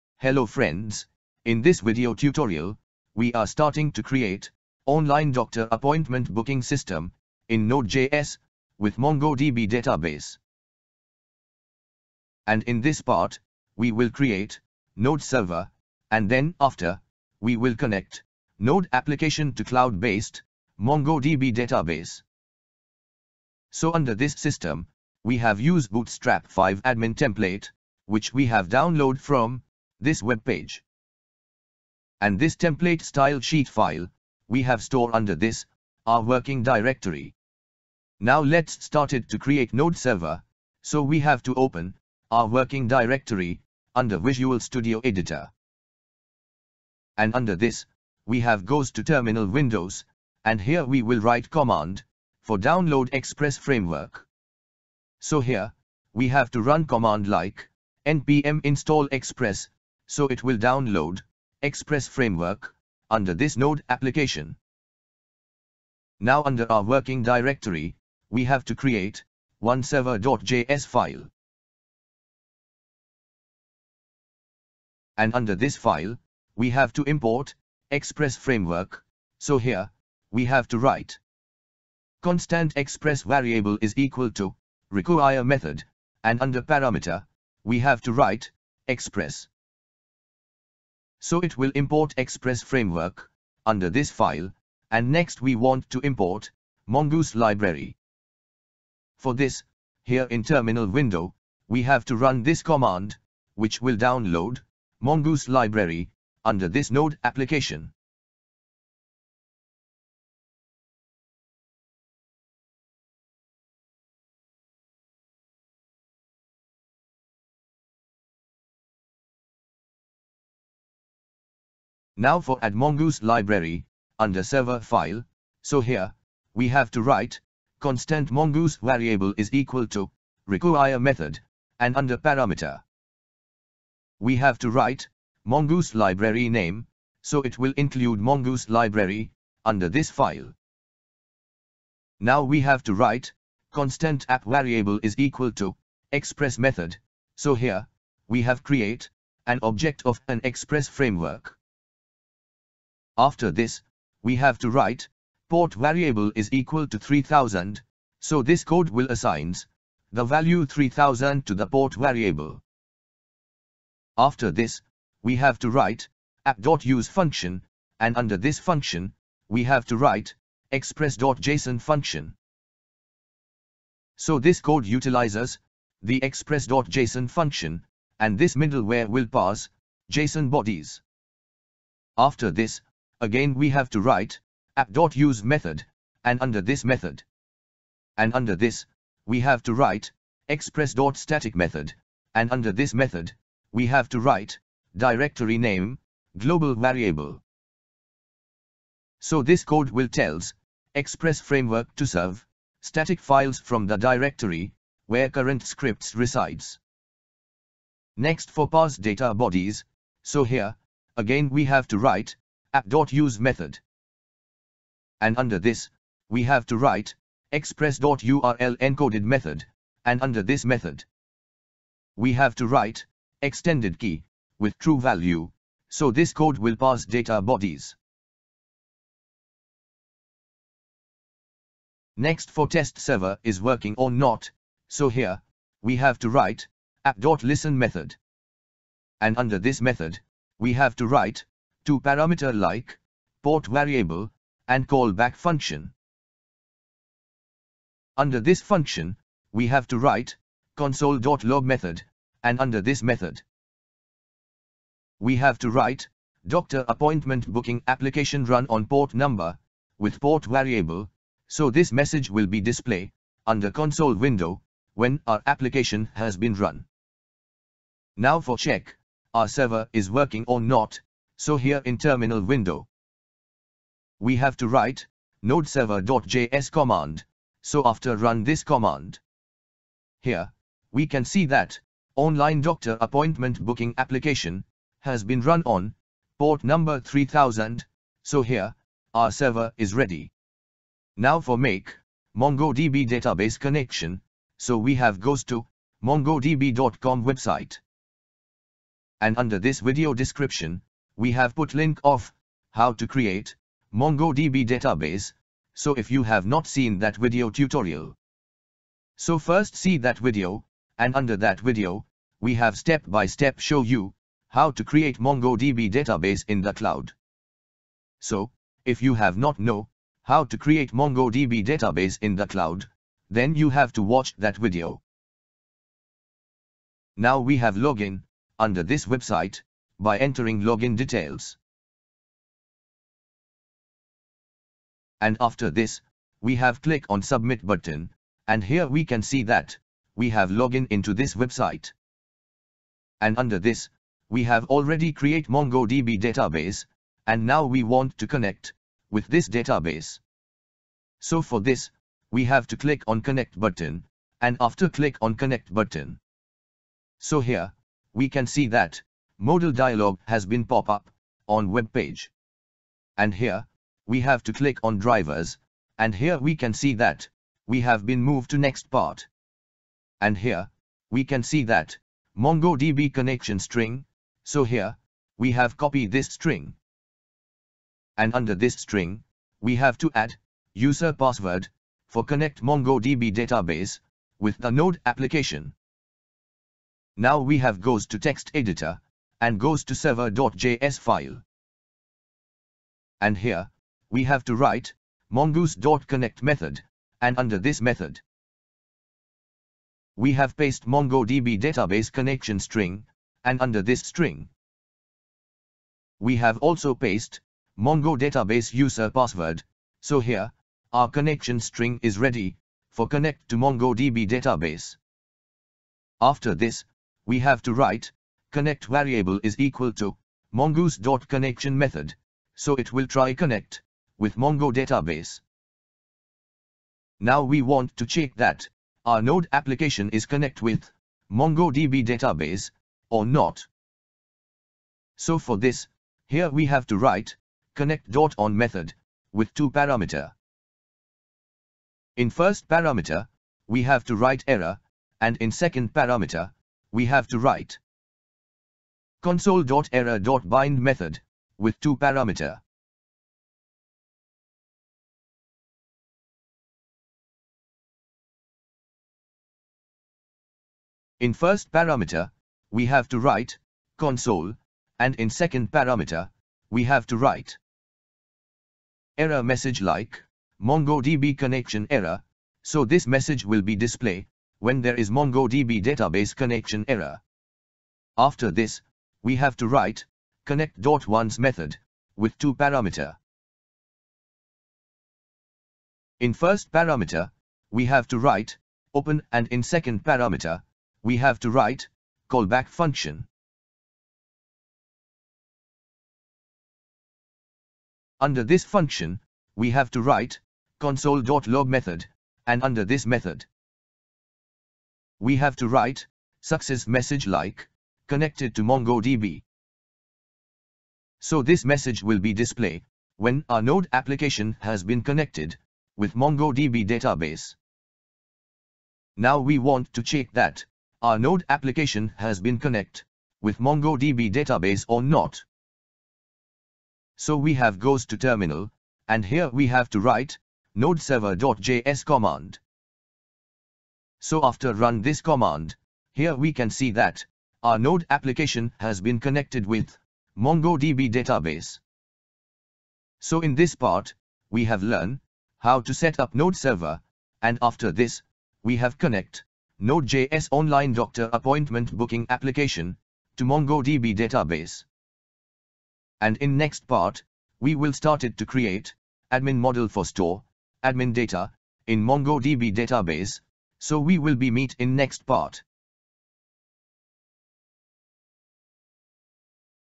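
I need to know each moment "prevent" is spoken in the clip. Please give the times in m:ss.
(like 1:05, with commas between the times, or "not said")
not said.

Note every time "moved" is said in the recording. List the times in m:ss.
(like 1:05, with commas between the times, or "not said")
6:08.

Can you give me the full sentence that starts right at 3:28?
Next for parse data bodies, so here, again we have to write app.use method.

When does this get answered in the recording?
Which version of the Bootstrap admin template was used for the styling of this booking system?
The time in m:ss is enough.
0:25.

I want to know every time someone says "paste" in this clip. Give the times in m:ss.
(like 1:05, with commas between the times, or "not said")
6:40, 6:46.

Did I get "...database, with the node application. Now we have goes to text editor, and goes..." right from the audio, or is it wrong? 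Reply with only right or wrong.
right.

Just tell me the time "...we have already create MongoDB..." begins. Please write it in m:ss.
5:44.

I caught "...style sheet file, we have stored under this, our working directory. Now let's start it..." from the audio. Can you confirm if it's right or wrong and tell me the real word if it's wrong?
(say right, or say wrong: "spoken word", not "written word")
right.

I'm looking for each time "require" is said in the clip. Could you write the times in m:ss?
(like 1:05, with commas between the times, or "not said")
1:24, 2:10.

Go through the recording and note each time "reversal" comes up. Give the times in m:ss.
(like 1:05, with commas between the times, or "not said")
not said.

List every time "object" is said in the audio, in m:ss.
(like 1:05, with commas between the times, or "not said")
2:29.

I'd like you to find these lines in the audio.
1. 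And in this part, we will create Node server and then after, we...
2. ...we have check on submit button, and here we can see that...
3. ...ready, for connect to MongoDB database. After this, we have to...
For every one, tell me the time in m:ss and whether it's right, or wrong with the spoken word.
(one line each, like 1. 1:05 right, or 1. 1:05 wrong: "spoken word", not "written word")
1. 0:12 right
2. 5:36 wrong: "click", not "check"
3. 6:52 right.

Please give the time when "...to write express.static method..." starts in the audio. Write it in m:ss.
3:09.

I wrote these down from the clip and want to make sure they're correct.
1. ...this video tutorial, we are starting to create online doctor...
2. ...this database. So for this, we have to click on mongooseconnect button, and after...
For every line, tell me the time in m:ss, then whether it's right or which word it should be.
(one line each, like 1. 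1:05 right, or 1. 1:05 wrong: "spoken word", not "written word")
1. 0:01 right
2. 5:49 wrong: "connect", not "mongooseconnect".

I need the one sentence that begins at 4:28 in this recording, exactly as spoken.
Now for check, our server is working or not, so here in terminal window.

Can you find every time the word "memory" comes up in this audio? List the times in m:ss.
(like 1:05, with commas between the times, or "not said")
not said.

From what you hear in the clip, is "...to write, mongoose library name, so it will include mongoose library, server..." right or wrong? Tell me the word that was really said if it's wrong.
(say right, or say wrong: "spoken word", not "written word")
wrong: "under", not "server".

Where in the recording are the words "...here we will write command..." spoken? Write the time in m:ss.
0:50.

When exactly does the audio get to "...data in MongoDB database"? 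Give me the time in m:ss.
9:21.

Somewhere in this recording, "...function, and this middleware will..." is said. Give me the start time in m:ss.
2:57.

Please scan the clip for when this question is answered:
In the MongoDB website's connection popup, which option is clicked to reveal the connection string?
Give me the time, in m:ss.
6:04.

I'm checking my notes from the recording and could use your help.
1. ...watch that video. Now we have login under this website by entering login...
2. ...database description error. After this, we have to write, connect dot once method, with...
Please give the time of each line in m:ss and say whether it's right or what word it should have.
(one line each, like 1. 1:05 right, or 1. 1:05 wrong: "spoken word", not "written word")
1. 5:24 right
2. 7:55 wrong: "connection", not "description".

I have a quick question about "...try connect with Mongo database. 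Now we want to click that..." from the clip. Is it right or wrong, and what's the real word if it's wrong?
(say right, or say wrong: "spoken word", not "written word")
wrong: "check", not "click".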